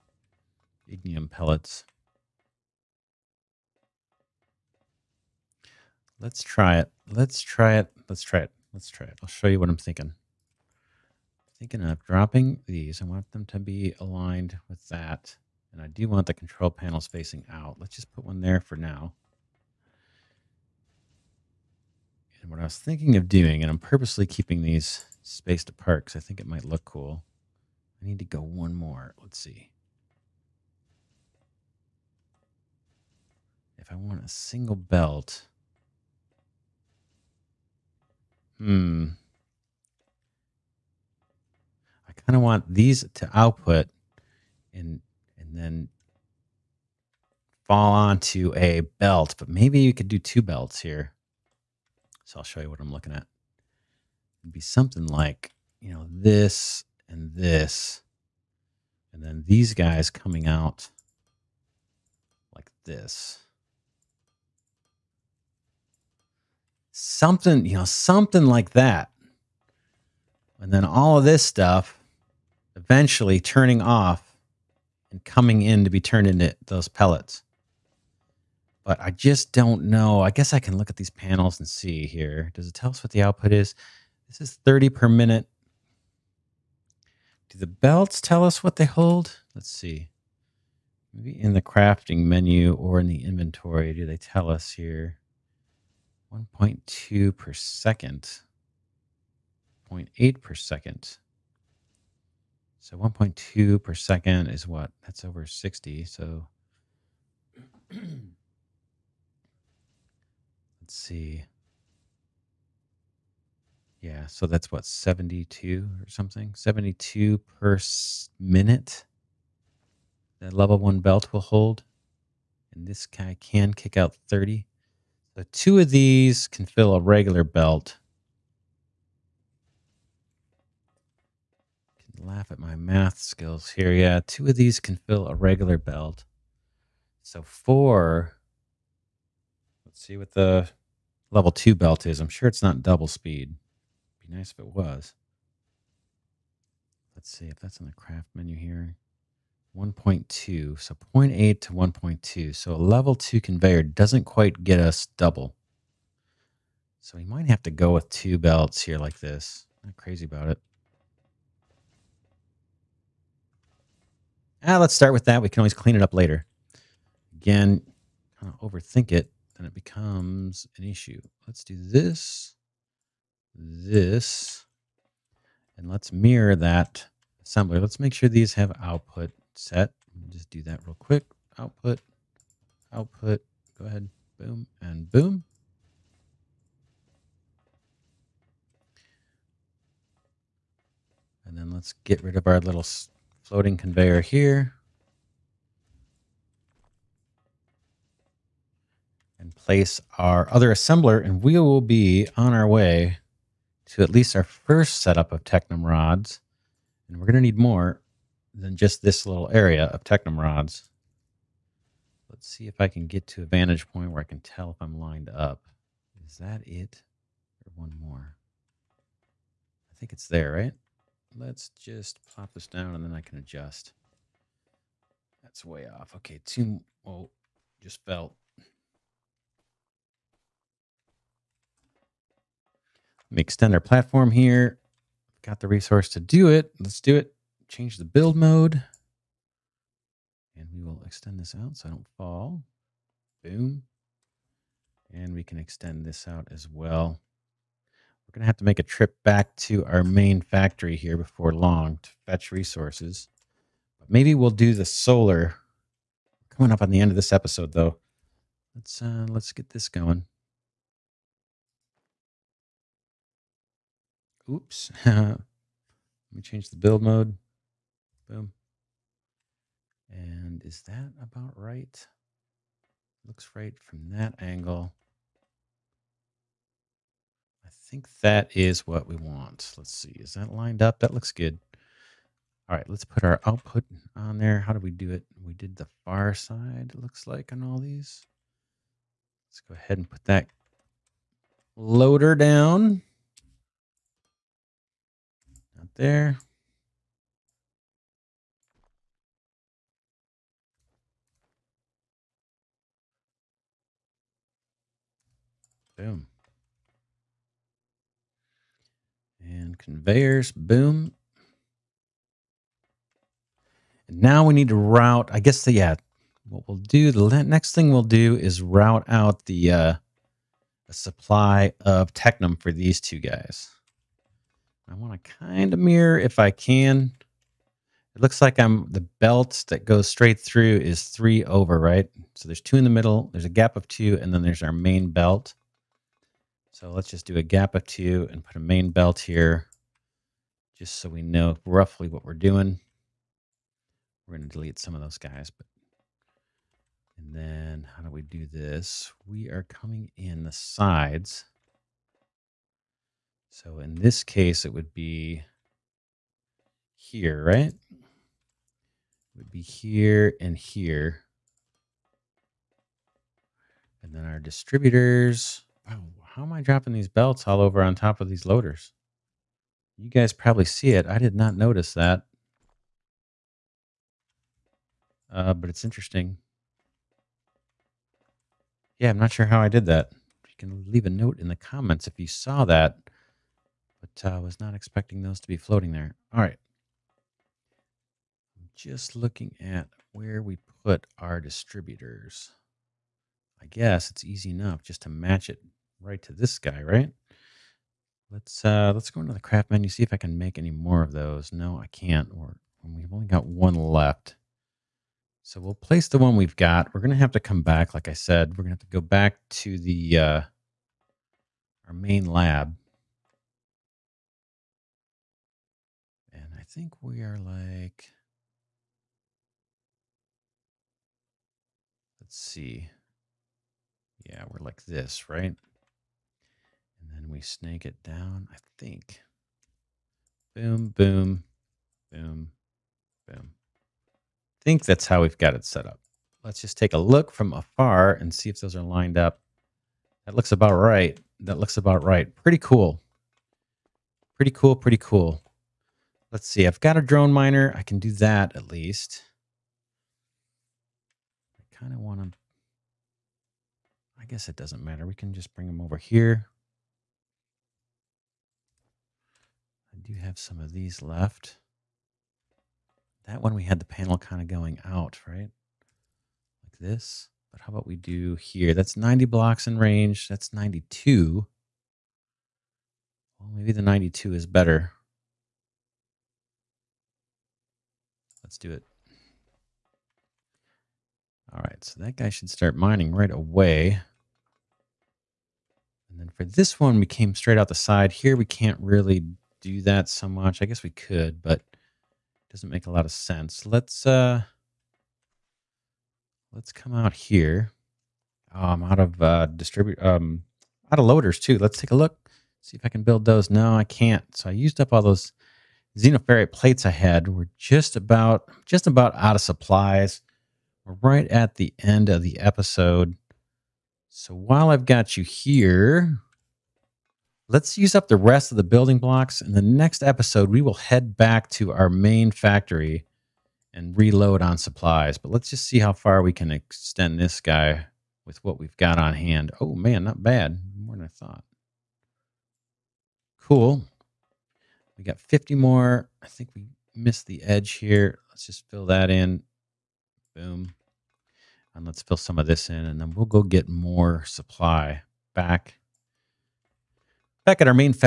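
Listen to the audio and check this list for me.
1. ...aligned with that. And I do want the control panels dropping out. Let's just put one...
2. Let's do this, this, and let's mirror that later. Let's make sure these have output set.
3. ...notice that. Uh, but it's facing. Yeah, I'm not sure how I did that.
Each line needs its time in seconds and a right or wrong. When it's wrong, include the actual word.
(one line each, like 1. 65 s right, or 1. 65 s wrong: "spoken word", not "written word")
1. 13 s wrong: "facing", not "dropping"
2. 171 s wrong: "assembler", not "later"
3. 371 s wrong: "interesting", not "facing".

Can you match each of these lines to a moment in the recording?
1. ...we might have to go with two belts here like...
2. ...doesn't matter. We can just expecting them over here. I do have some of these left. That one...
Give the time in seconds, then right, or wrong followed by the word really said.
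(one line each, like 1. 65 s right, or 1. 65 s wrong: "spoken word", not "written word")
1. 157 s right
2. 454 s wrong: "bring", not "expecting".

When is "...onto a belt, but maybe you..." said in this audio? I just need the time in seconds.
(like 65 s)
47 s.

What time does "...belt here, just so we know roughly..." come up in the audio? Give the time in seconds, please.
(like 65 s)
338 s.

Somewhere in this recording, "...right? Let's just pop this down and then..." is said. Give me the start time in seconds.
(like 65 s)
220 s.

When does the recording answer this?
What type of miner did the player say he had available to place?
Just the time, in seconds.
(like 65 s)
447 s.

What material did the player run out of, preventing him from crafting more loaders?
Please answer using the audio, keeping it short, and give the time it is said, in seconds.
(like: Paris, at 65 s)
xenoferrite plates, at 505 s.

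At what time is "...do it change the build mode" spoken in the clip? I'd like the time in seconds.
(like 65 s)
236 s.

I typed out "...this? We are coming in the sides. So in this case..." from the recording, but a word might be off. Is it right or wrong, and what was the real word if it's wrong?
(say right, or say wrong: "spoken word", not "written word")
right.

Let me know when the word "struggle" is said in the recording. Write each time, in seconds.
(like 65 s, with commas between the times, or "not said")
not said.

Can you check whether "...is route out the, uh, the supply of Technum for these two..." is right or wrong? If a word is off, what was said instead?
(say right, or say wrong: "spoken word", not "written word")
right.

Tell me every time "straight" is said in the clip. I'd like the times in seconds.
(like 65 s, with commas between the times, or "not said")
330 s, 487 s.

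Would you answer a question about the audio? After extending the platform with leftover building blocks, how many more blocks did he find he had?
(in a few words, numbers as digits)
50.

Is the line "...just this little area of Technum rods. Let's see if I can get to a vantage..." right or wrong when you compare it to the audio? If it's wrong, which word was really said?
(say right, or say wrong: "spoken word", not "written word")
right.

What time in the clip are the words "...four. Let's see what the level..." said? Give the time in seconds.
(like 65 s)
137 s.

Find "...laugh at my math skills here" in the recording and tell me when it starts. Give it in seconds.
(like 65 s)
132 s.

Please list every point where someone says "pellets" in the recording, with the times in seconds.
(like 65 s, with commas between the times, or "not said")
1 s, 76 s.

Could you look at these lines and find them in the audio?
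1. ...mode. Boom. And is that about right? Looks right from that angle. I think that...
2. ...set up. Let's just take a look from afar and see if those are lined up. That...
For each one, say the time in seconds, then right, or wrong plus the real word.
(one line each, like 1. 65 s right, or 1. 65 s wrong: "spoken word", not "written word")
1. 267 s right
2. 435 s right.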